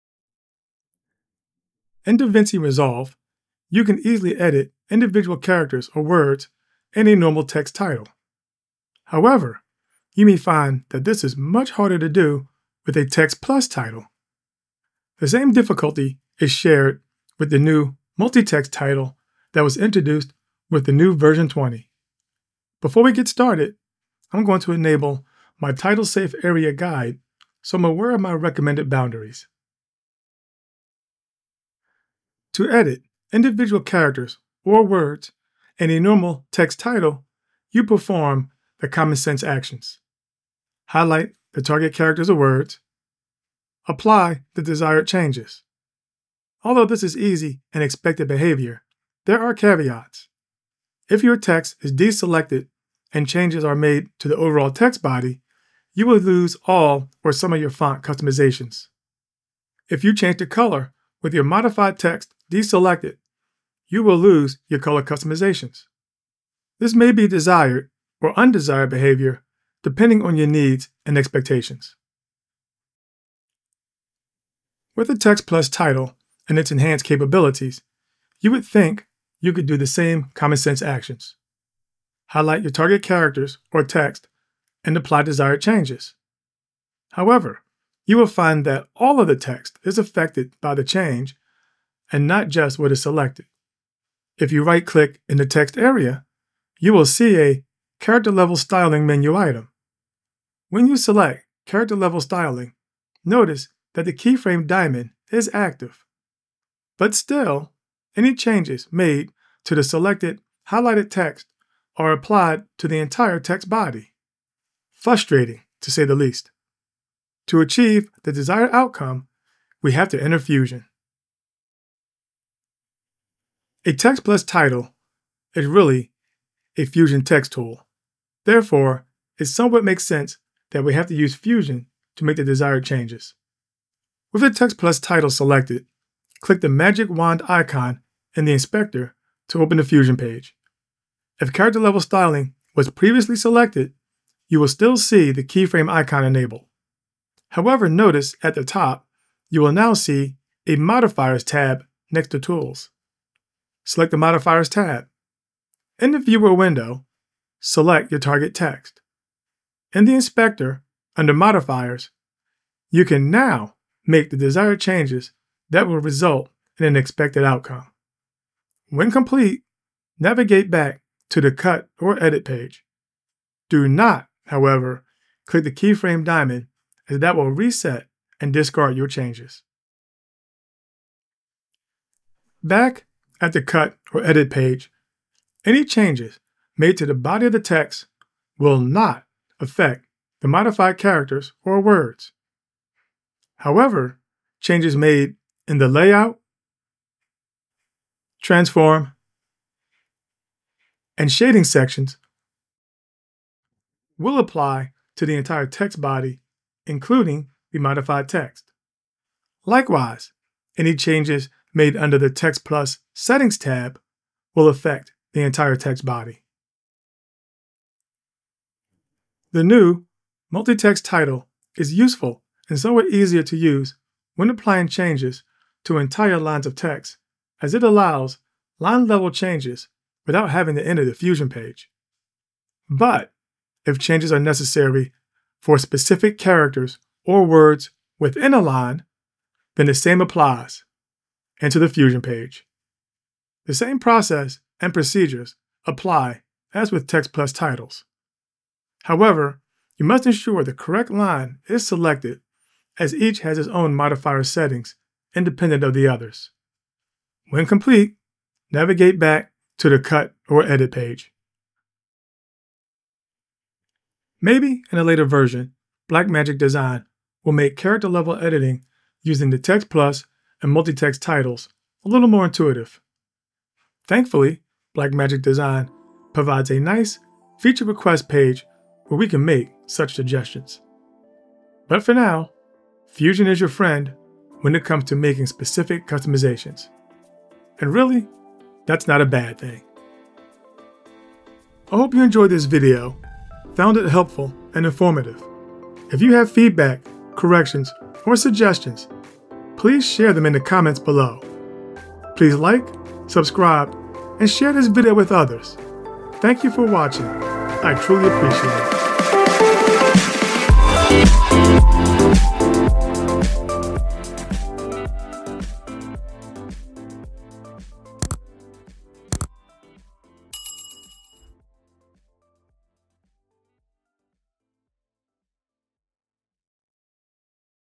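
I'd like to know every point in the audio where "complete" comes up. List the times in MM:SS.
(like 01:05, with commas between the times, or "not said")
02:49, 04:17.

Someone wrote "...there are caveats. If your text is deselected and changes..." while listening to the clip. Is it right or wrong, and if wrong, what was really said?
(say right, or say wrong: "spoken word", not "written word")
right.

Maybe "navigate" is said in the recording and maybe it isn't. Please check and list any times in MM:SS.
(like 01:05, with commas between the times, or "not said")
02:50, 04:18.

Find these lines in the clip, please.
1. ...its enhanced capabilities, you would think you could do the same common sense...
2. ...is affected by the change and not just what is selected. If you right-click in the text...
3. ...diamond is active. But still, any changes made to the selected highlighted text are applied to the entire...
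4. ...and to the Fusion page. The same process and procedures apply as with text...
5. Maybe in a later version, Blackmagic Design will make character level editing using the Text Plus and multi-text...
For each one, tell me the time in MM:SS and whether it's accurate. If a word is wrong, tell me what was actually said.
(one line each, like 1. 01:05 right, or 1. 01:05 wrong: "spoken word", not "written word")
1. 01:16 right
2. 01:29 right
3. 01:44 right
4. 04:01 right
5. 04:24 right.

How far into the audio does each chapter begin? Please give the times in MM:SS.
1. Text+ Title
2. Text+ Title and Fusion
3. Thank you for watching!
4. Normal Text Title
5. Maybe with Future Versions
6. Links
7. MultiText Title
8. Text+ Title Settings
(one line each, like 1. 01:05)
1. 01:12
2. 02:01
3. 04:50
4. 00:30
5. 04:22
6. 05:13
7. 03:37
8. 03:00.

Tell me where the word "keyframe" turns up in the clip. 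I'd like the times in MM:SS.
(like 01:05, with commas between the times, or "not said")
01:44, 02:25, 02:55.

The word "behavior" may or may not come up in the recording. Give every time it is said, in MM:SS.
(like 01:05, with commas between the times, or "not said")
00:48, 01:08.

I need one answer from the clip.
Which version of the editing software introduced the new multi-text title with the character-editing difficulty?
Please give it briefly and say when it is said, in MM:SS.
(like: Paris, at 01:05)
20, at 00:21.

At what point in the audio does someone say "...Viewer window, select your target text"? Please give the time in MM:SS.
02:36.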